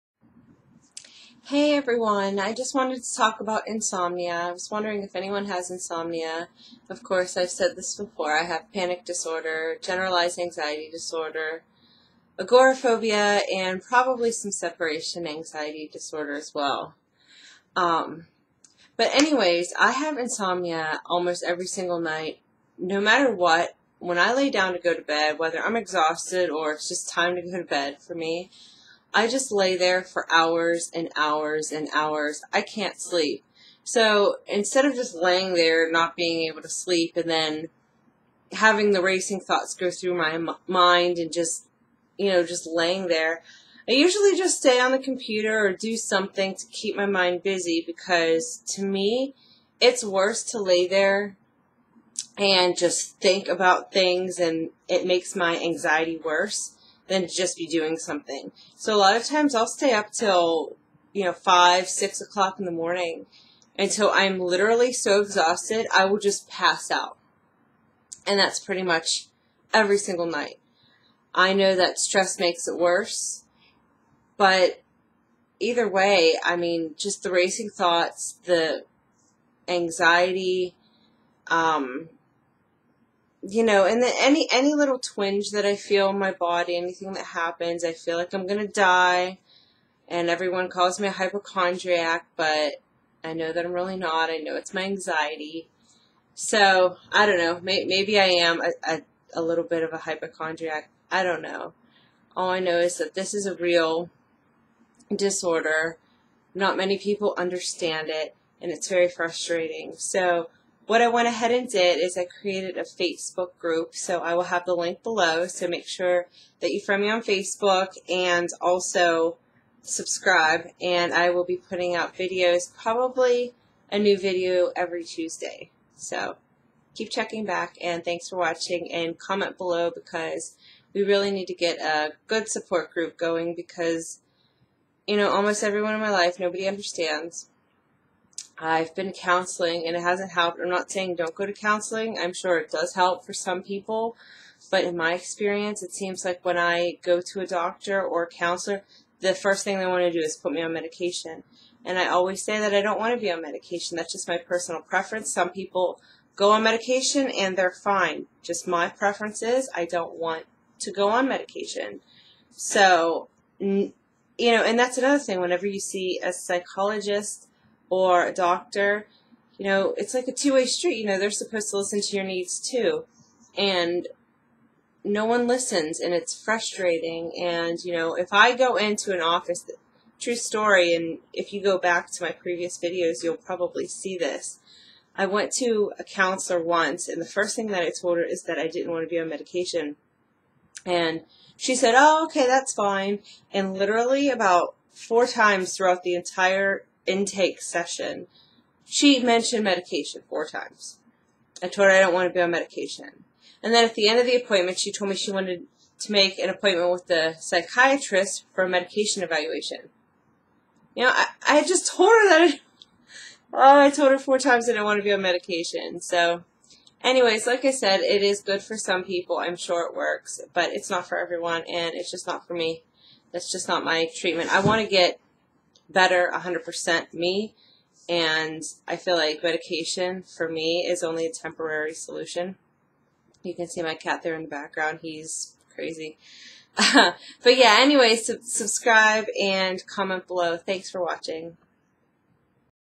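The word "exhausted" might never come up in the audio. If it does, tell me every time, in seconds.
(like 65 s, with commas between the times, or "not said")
25 s, 65 s.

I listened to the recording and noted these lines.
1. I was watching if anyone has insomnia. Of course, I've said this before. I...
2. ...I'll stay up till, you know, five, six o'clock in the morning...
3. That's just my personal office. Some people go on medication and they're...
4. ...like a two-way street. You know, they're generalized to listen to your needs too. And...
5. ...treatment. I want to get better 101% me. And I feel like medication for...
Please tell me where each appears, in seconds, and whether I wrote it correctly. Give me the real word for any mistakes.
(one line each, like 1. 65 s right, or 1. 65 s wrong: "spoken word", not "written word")
1. 4 s wrong: "wondering", not "watching"
2. 59 s right
3. 153 s wrong: "preference", not "office"
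4. 170 s wrong: "supposed", not "generalized"
5. 224 s wrong: "100", not "101".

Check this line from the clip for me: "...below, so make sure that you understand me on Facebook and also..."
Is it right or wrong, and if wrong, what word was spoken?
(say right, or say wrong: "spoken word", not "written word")
wrong: "friend", not "understand".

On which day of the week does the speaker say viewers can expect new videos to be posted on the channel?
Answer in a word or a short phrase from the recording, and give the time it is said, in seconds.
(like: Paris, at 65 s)
Tuesday, at 125 s.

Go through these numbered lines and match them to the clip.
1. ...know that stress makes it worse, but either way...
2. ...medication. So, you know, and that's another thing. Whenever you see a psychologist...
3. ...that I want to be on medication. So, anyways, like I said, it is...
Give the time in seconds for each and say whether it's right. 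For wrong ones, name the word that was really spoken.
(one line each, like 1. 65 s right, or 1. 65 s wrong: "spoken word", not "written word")
1. 71 s right
2. 161 s right
3. 214 s right.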